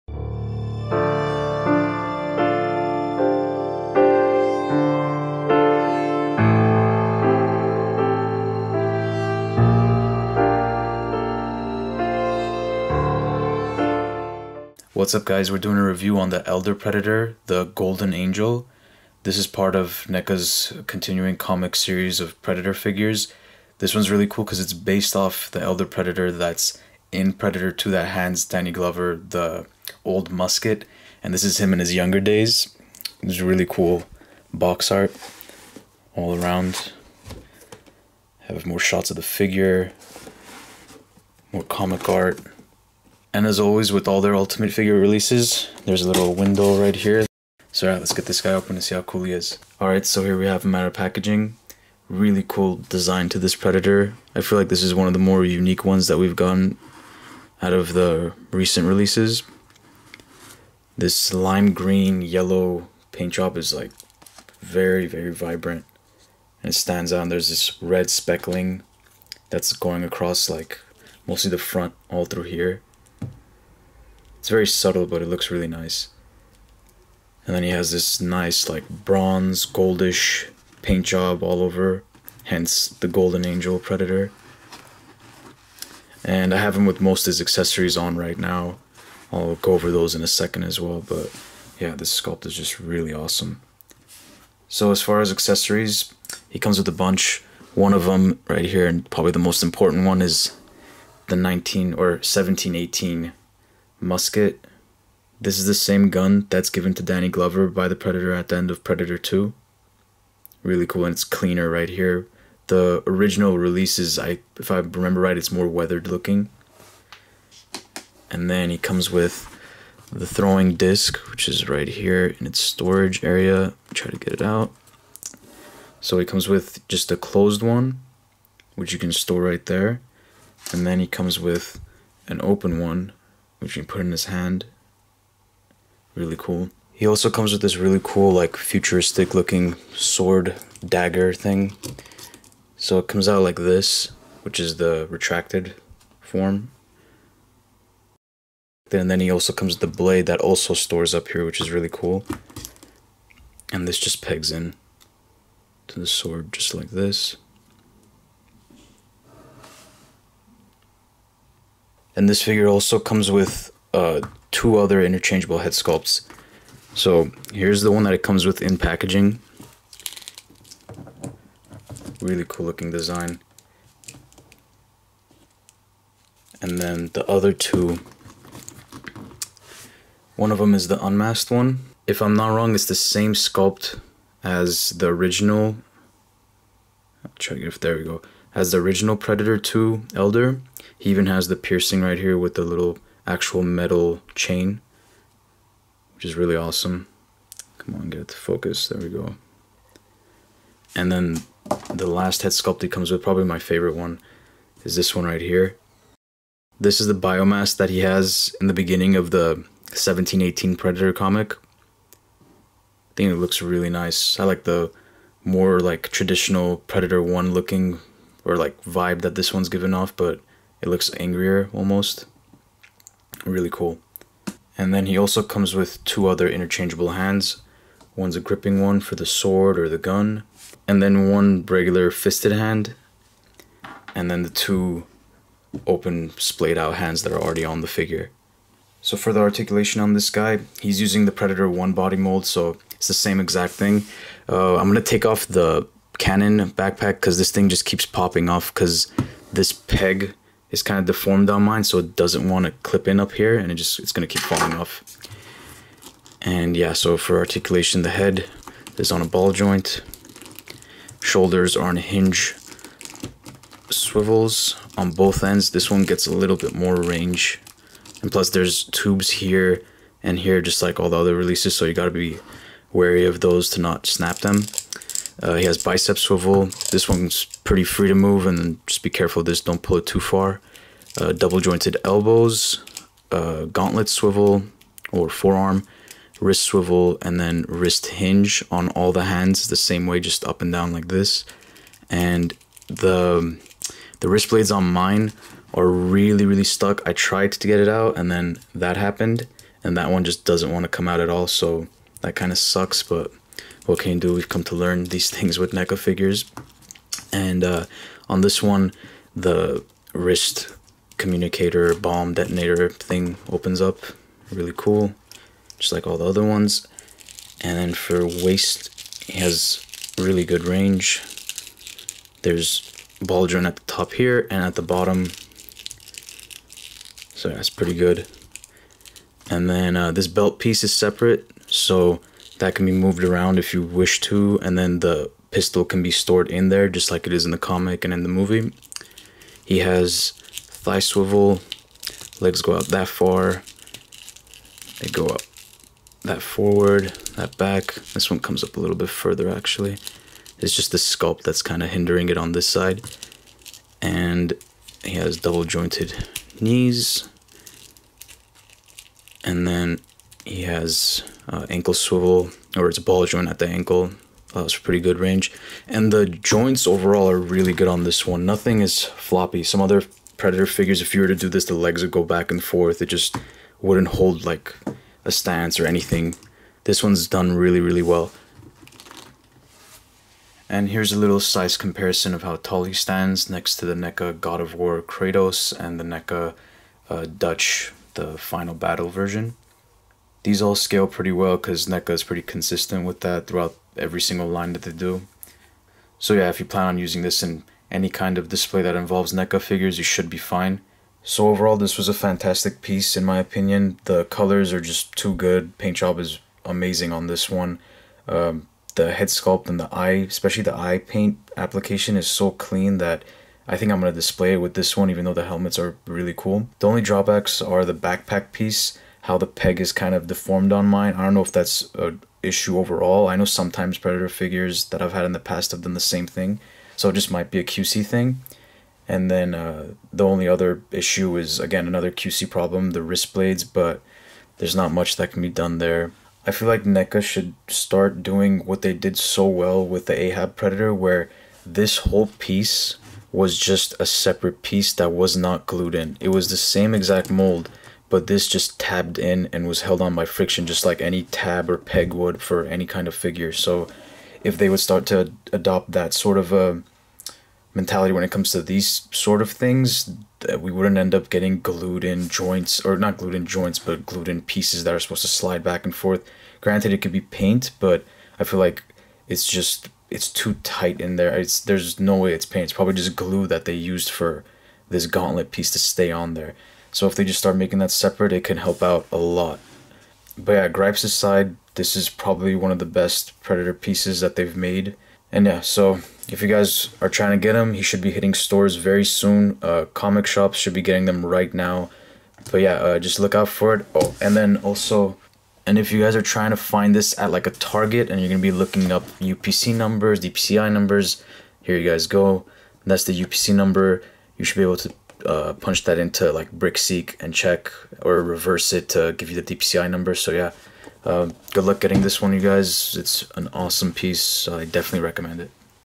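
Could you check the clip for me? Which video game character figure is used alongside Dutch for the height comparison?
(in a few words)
Kratos.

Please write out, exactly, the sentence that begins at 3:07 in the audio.
I'll check if there we go.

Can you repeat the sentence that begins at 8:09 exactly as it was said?
Uh, comic shops should be getting them right now.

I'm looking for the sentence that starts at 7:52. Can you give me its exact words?
It's probably just glue that they used for this gauntlet piece to stay on there.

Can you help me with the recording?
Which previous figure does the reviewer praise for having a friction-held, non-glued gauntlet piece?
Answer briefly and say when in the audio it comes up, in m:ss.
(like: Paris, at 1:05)
Ahab Predator, at 7:20.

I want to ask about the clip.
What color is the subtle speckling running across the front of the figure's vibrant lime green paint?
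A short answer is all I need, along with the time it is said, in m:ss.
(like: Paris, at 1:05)
red, at 1:07.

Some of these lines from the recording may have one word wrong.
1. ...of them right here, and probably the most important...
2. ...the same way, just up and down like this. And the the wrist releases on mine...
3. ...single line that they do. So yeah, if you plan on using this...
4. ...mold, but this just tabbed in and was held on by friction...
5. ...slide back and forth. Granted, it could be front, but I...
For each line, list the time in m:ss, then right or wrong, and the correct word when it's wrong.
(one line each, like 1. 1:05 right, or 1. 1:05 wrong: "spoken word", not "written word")
1. 1:37 right
2. 4:49 wrong: "blades", not "releases"
3. 6:34 right
4. 7:27 right
5. 7:45 wrong: "paint", not "front".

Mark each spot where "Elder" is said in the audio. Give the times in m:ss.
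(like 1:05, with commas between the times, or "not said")
0:16, 0:25, 3:10.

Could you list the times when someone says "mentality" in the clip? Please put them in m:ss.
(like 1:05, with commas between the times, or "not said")
7:37.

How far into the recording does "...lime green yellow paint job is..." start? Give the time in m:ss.
1:01.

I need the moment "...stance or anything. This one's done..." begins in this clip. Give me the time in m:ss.
6:15.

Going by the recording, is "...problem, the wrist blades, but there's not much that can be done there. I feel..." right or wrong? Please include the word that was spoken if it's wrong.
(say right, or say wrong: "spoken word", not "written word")
right.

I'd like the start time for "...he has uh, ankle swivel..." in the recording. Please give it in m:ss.
6:00.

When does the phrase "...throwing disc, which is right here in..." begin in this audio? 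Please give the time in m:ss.
2:00.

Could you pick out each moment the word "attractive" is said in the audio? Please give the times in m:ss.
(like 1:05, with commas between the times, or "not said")
not said.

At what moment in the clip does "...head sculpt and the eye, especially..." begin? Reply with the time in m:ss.
6:49.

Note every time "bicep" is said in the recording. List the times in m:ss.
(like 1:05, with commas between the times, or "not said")
4:35.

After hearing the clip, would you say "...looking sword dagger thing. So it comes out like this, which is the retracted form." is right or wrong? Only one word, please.
right.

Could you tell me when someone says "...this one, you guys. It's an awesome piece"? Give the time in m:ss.
8:32.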